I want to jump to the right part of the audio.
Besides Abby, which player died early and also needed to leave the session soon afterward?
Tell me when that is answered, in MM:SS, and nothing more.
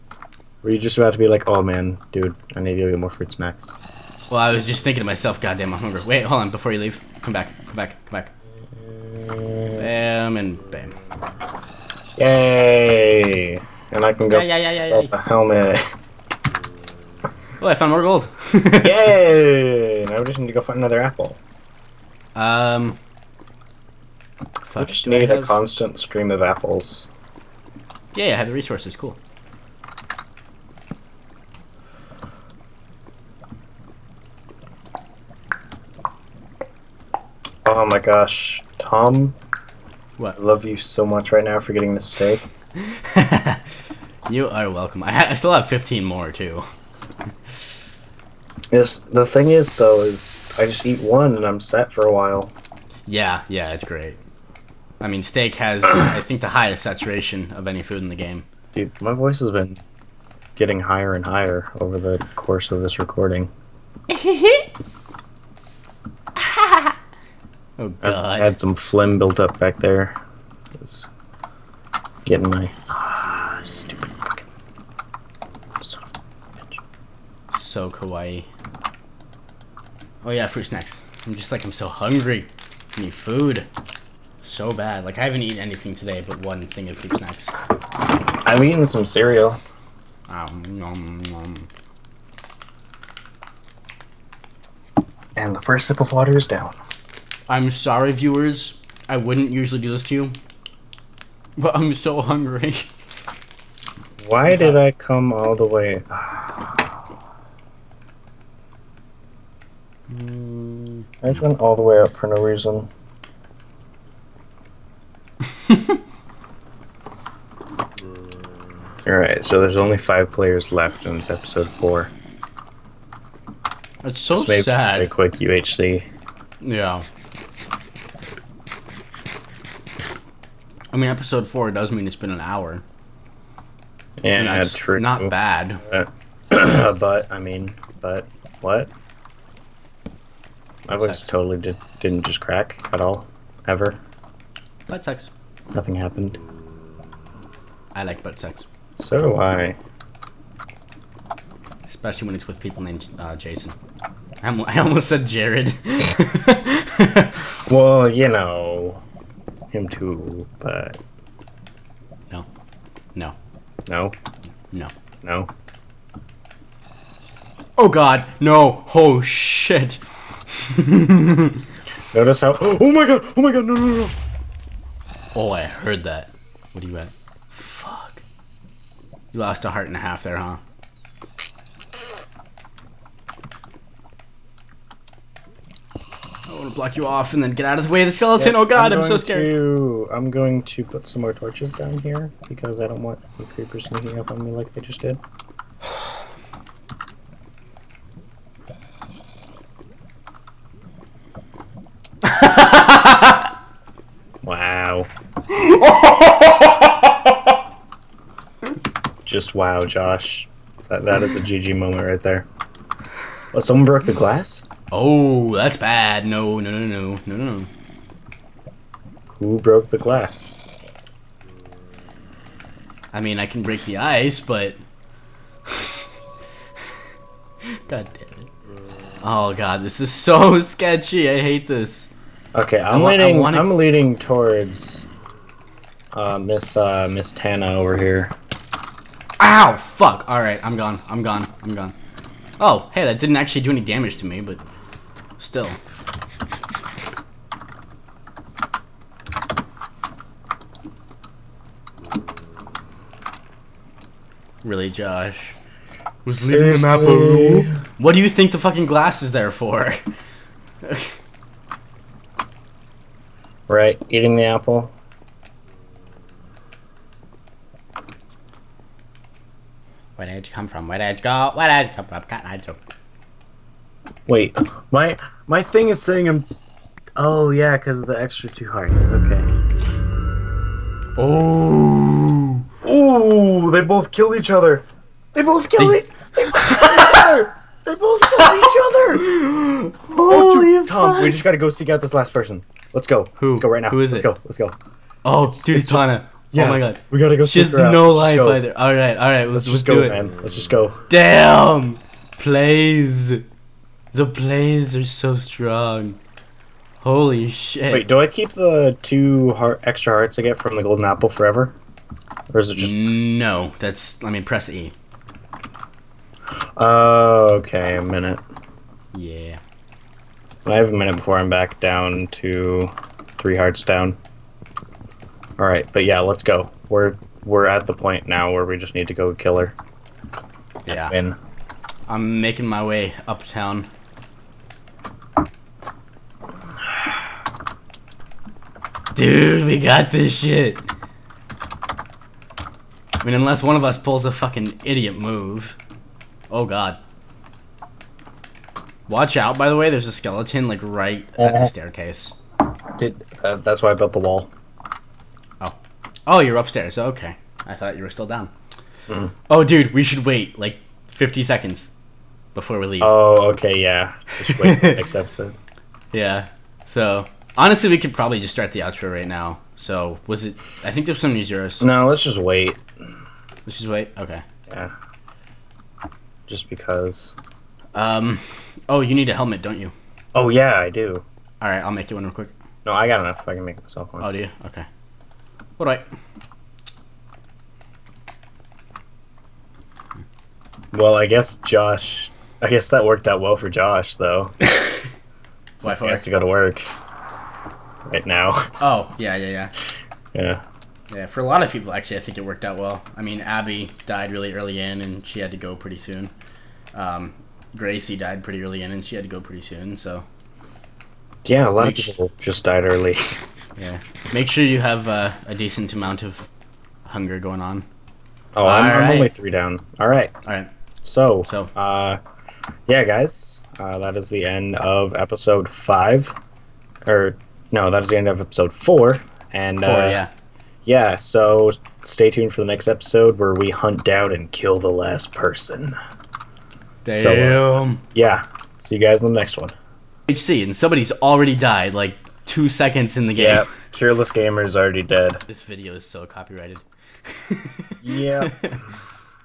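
06:47.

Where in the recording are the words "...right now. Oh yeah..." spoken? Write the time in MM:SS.
06:38.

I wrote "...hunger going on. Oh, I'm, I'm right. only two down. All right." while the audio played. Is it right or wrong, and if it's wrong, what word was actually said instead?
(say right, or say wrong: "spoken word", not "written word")
wrong: "three", not "two".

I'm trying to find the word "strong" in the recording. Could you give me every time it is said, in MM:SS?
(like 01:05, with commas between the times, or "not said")
05:05.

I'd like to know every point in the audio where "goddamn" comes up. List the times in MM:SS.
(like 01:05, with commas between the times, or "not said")
00:05.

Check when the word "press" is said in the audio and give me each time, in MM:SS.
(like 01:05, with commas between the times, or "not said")
05:14.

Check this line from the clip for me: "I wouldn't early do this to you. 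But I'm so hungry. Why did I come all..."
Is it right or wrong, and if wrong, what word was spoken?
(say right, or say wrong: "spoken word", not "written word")
wrong: "usually", not "early".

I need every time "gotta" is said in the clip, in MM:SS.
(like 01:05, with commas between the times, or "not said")
04:51, 04:57.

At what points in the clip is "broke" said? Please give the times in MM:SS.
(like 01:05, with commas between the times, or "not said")
03:33, 03:39.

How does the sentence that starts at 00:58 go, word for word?
Dude, my voice has been getting higher and higher over the course of this recording.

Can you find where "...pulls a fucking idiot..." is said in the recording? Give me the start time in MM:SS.
05:43.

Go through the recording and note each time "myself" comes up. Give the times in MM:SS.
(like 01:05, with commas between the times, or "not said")
00:05, 06:23.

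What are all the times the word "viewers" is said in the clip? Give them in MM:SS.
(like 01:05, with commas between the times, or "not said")
01:38.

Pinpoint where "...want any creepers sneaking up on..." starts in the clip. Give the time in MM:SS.
03:13.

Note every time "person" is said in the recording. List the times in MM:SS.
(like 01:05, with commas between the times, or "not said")
04:52, 07:15.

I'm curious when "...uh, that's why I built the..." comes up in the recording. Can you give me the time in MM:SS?
05:53.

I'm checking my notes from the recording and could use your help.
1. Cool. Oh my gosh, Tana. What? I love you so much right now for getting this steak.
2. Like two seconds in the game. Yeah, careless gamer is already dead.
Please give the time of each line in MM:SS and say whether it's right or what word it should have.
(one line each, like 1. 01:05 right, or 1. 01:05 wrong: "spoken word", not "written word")
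1. 00:28 wrong: "Tom", not "Tana"
2. 07:21 right.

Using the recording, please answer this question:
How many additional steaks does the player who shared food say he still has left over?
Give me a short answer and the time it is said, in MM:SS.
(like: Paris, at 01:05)
15, at 00:45.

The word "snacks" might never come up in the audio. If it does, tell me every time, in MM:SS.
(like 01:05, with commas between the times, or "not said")
00:03, 01:20, 01:27.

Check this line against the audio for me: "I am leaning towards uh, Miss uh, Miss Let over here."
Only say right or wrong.
wrong.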